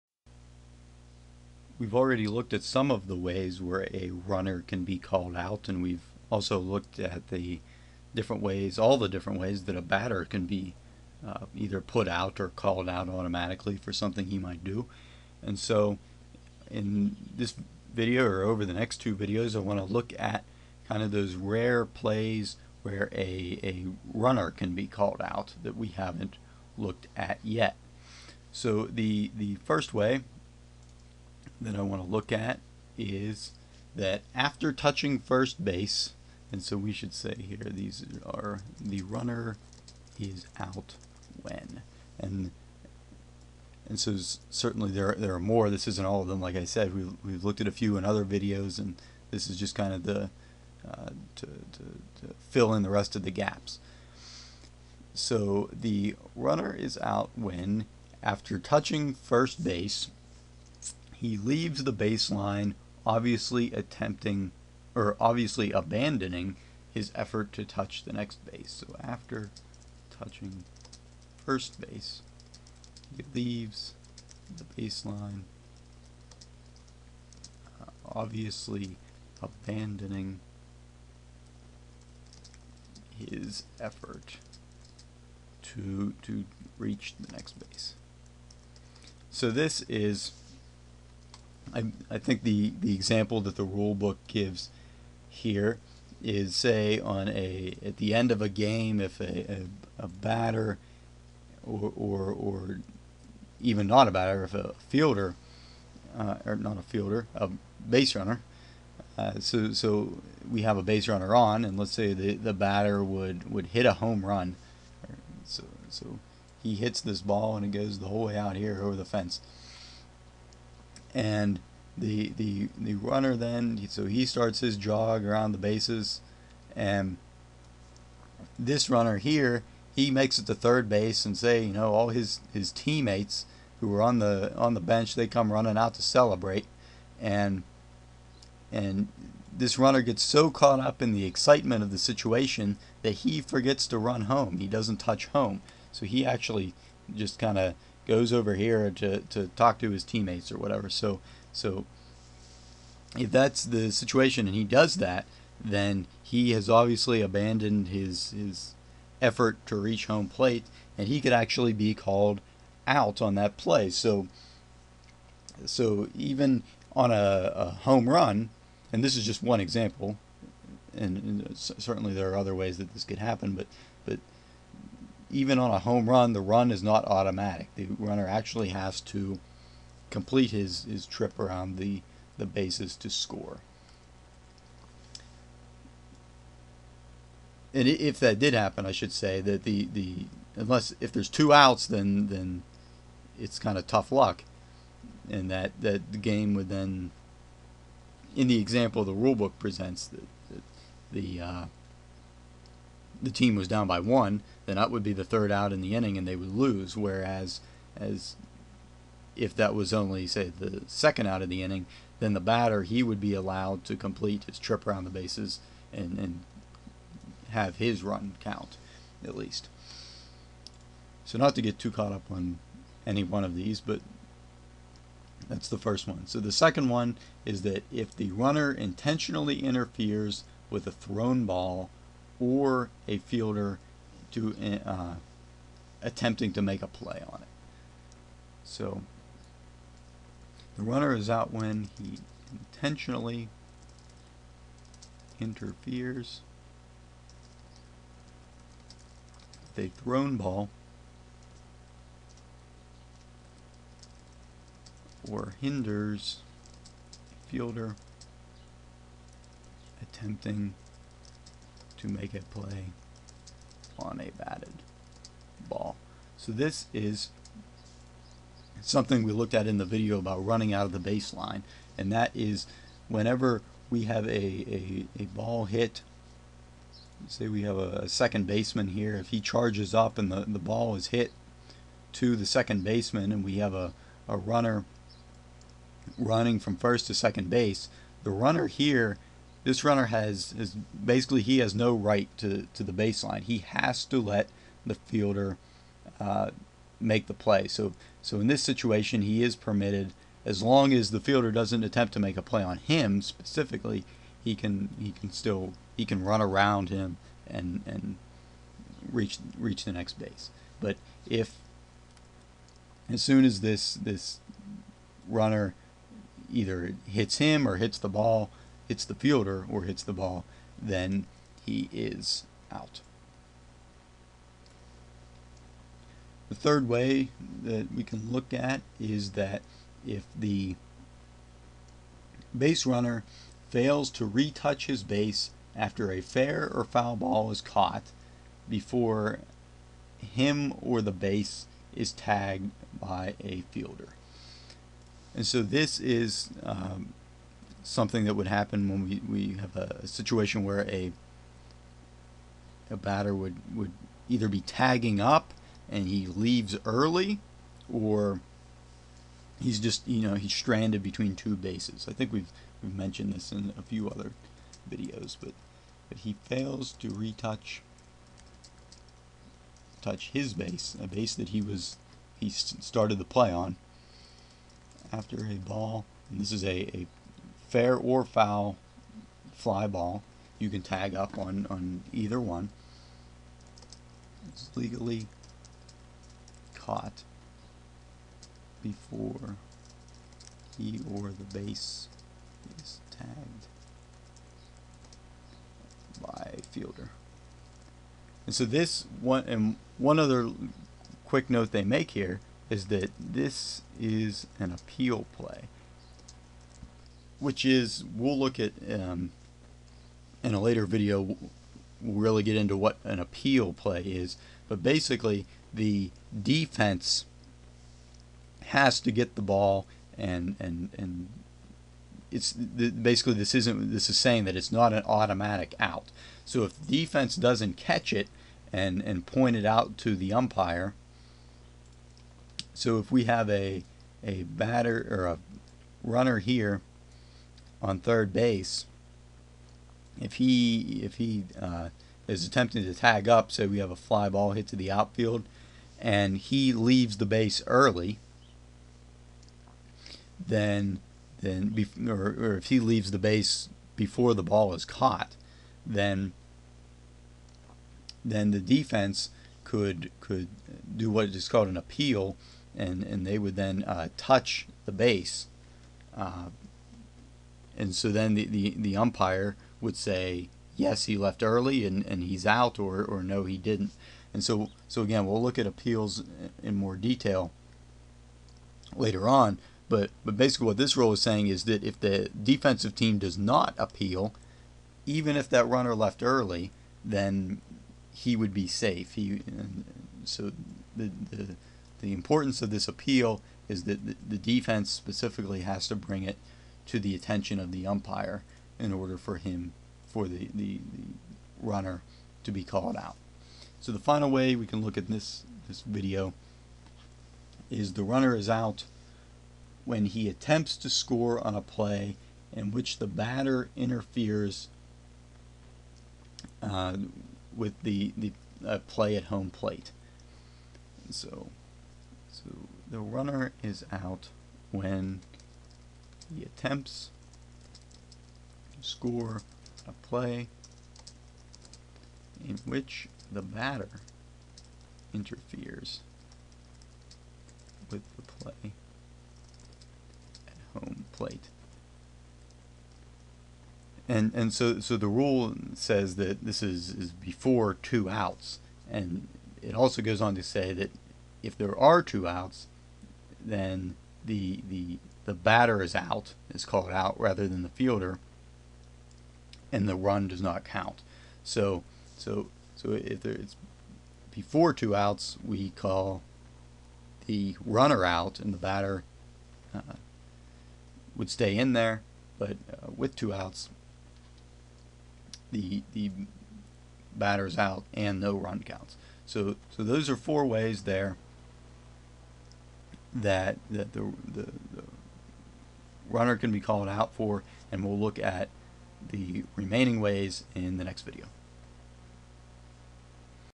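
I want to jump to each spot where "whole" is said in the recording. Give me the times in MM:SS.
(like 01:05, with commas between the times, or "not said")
01:58.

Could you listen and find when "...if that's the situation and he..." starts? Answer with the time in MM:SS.
02:33.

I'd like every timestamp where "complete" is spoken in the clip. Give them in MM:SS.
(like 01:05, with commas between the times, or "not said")
03:00, 03:33.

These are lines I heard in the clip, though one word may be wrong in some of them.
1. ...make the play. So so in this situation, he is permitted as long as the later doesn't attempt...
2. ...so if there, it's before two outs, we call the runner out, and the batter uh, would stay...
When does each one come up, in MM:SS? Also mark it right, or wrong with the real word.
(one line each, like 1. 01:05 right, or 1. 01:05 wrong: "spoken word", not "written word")
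1. 04:56 wrong: "fielder", not "later"
2. 09:22 right.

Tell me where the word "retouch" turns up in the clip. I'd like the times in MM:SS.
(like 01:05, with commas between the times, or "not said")
05:34, 06:07.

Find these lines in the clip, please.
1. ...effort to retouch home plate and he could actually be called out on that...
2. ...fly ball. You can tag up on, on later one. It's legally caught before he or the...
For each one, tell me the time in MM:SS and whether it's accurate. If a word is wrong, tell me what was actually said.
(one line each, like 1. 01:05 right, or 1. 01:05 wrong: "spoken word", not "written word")
1. 02:39 wrong: "reach", not "retouch"
2. 06:19 wrong: "either", not "later".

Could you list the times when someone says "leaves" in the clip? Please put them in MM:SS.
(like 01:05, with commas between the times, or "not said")
01:01, 01:13, 05:56, 07:26, 07:32.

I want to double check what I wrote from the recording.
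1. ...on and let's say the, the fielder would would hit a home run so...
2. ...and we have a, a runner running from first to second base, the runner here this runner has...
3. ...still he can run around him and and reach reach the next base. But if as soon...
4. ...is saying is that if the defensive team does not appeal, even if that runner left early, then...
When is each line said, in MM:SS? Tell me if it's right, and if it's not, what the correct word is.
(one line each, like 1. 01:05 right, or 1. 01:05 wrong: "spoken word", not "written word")
1. 01:51 wrong: "batter", not "fielder"
2. 04:43 right
3. 05:05 right
4. 08:01 right.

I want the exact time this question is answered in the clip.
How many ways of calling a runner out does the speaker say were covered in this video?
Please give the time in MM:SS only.
09:40.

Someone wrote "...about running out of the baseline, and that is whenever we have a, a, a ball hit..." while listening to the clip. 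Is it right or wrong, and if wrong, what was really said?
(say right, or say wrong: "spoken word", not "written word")
right.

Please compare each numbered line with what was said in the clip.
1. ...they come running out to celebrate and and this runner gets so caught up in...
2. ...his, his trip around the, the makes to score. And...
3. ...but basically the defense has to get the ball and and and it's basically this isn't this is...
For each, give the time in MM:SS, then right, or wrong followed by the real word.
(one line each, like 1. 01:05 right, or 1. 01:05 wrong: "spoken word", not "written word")
1. 02:15 right
2. 03:00 wrong: "bases", not "makes"
3. 06:54 right.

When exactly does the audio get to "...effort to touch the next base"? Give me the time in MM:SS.
01:07.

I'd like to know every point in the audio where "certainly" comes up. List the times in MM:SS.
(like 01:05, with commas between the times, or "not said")
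00:44, 02:51.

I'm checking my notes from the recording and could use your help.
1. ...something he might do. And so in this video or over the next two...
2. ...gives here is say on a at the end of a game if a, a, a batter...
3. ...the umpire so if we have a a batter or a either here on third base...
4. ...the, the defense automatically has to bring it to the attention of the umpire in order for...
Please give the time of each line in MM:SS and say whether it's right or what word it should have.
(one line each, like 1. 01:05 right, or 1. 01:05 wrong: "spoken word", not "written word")
1. 00:13 right
2. 01:34 right
3. 07:10 wrong: "runner", not "either"
4. 08:14 wrong: "specifically", not "automatically".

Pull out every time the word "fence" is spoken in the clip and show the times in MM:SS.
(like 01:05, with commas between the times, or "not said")
01:59.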